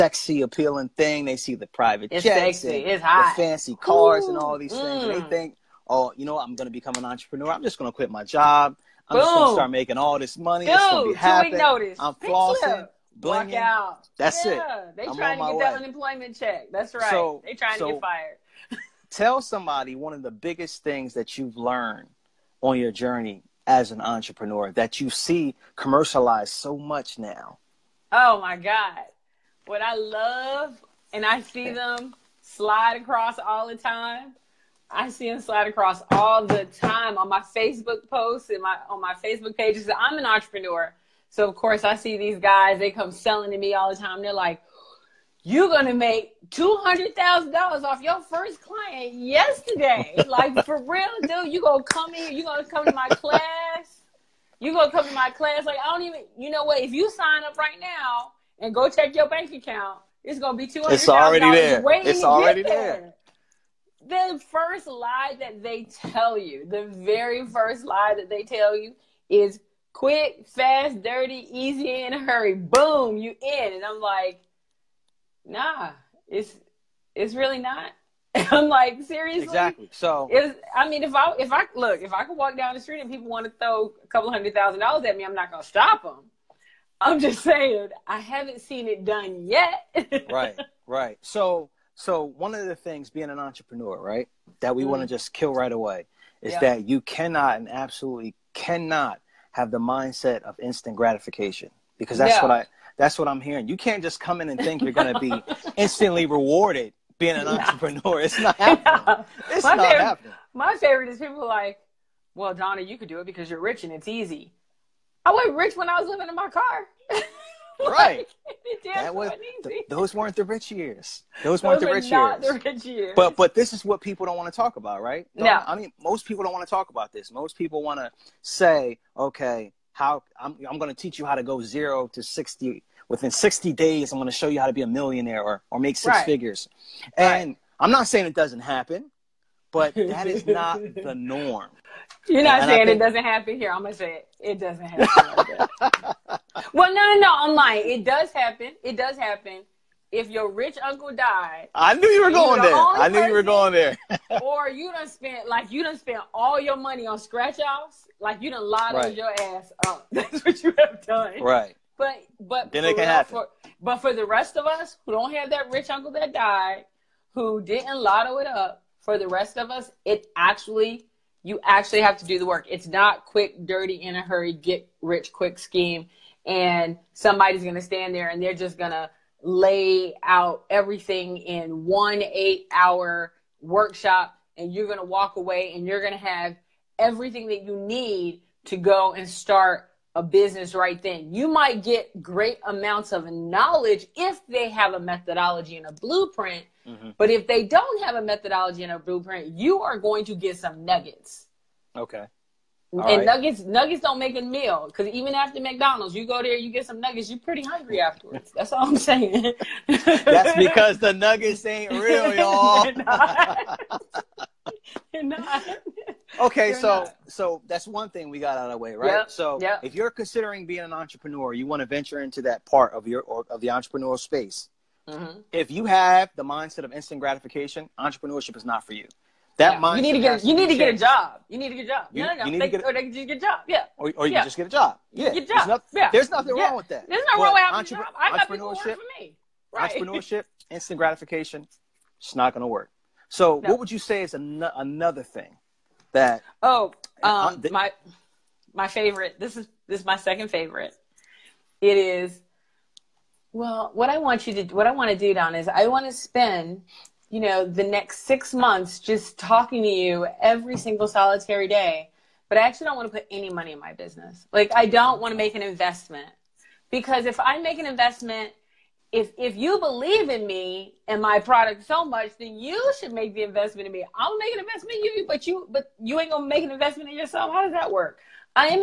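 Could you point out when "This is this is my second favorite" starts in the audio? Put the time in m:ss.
4:09.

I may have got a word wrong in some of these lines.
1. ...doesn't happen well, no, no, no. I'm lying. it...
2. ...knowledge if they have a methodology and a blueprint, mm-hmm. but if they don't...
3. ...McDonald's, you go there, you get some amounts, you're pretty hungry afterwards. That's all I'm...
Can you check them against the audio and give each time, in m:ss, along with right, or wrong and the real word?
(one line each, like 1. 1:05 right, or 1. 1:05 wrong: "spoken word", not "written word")
1. 2:24 right
2. 3:13 right
3. 3:25 wrong: "nuggets", not "amounts".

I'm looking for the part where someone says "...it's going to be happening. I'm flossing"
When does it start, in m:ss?
0:10.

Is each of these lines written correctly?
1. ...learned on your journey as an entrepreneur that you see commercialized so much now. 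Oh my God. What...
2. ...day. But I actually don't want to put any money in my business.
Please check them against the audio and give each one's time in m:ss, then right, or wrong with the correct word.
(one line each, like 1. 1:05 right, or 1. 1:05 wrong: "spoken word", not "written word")
1. 0:21 right
2. 4:21 right.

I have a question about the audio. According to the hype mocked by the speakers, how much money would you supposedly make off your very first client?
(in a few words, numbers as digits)
$200,000.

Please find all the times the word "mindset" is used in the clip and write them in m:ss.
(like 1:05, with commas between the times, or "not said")
1:39, 3:46.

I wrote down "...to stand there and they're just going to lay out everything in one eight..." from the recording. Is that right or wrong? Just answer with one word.
right.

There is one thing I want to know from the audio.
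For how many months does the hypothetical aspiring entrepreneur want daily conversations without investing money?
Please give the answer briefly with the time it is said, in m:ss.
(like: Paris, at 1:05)
6, at 4:18.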